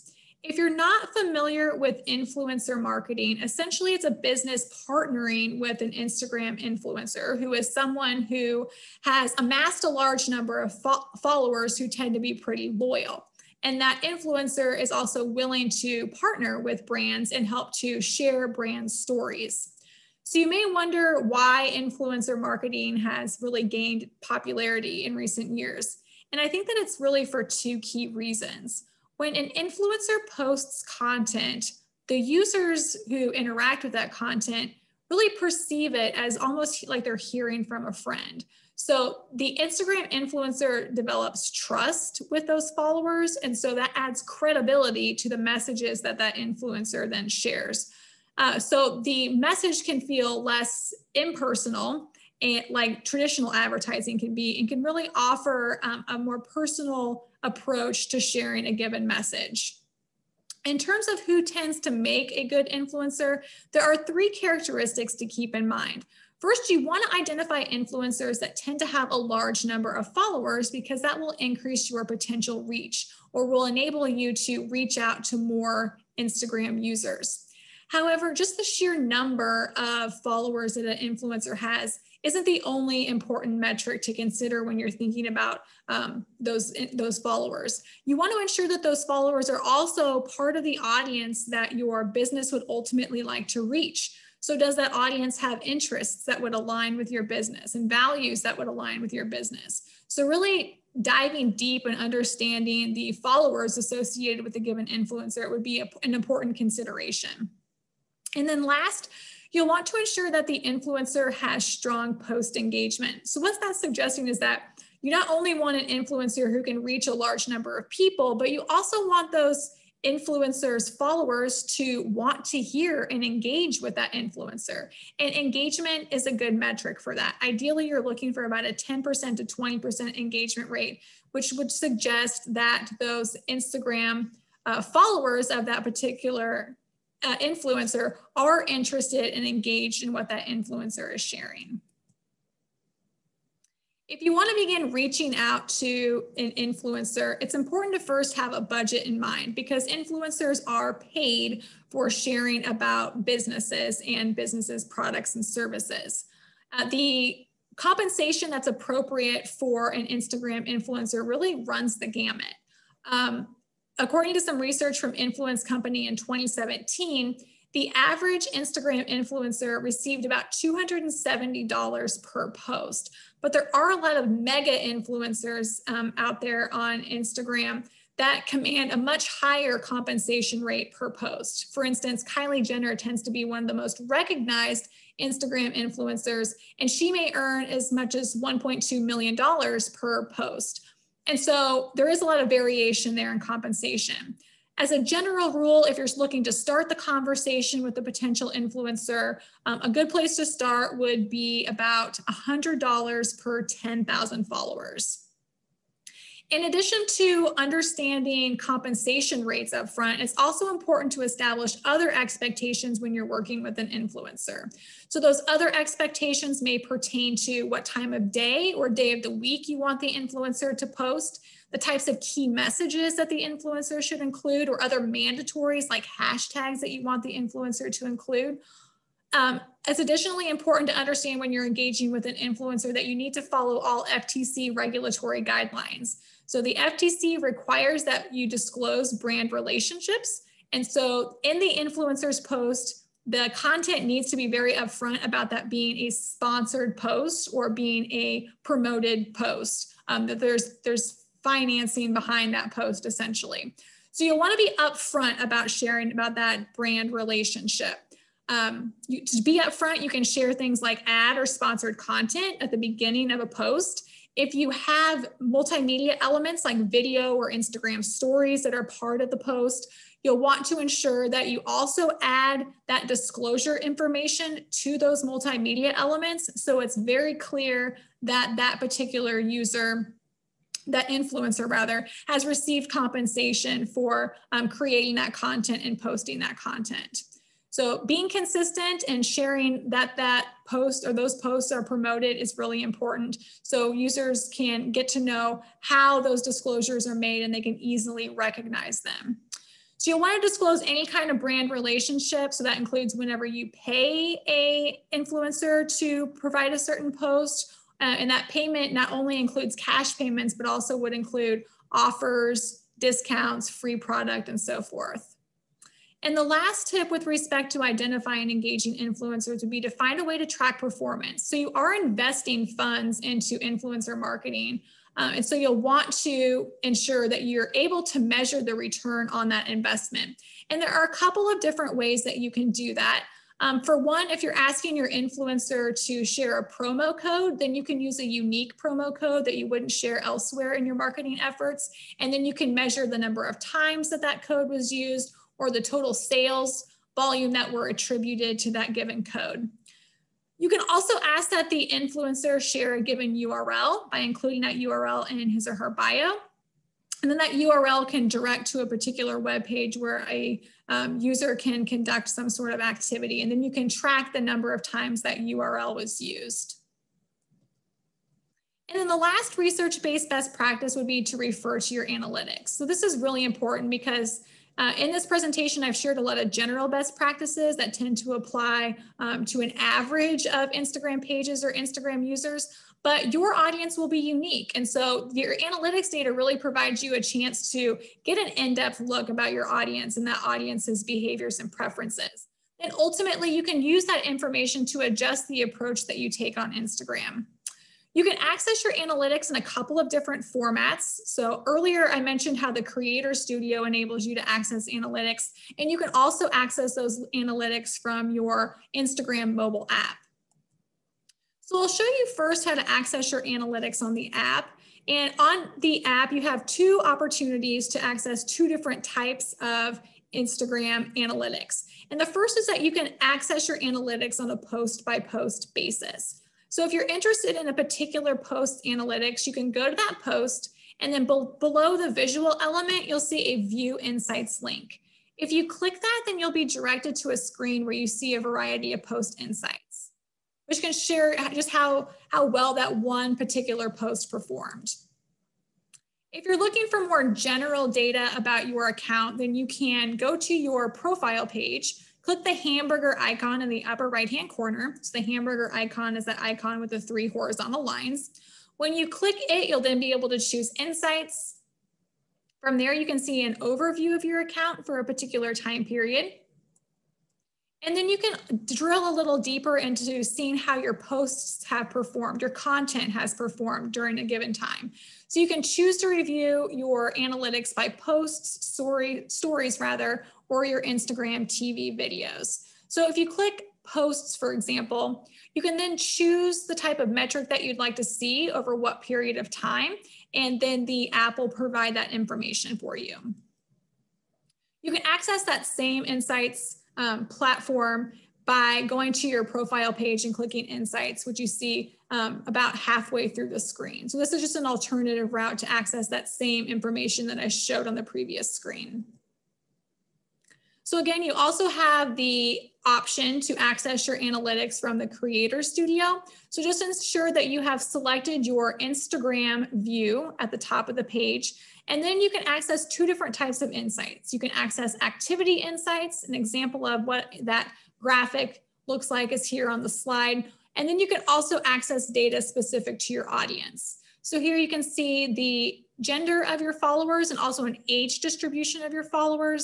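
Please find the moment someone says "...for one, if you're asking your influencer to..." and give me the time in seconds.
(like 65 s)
333 s.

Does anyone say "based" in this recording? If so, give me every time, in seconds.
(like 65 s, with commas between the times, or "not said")
369 s.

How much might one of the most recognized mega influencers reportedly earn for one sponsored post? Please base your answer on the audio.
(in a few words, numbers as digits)
$1.2 million.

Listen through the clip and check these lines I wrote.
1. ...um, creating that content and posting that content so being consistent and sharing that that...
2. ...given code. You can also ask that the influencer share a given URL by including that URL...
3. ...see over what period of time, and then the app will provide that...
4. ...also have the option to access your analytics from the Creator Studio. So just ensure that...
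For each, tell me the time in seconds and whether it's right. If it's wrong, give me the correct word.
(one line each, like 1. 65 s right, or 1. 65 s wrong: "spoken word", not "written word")
1. 284 s right
2. 348 s right
3. 488 s right
4. 511 s right.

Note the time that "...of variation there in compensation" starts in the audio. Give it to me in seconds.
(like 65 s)
192 s.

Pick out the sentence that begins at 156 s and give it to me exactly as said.
Uh, the compensation that's appropriate for an Instagram influencer really runs the gamut.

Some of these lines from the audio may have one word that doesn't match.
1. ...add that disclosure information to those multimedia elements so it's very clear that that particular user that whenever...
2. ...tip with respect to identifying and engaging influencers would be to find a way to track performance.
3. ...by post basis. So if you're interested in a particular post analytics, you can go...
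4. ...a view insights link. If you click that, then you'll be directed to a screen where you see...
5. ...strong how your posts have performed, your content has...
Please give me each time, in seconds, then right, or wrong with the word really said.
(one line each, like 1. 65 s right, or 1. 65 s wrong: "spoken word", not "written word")
1. 272 s wrong: "influencer", not "whenever"
2. 316 s right
3. 425 s right
4. 433 s right
5. 470 s wrong: "seeing", not "strong".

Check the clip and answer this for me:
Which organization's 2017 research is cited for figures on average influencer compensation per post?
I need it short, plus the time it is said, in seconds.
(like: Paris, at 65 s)
Influence Company, at 165 s.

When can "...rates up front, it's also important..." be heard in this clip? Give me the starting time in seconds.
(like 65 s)
209 s.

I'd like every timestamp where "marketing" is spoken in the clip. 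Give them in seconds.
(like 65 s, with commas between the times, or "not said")
2 s, 22 s, 324 s, 340 s.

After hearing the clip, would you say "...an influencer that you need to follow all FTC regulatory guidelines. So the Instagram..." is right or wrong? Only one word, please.
wrong.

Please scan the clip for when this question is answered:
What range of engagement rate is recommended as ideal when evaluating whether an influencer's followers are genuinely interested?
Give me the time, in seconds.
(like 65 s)
128 s.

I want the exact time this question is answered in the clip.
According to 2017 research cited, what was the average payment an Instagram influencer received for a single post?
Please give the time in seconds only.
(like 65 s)
170 s.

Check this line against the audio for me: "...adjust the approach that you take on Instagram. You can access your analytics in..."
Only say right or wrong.
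right.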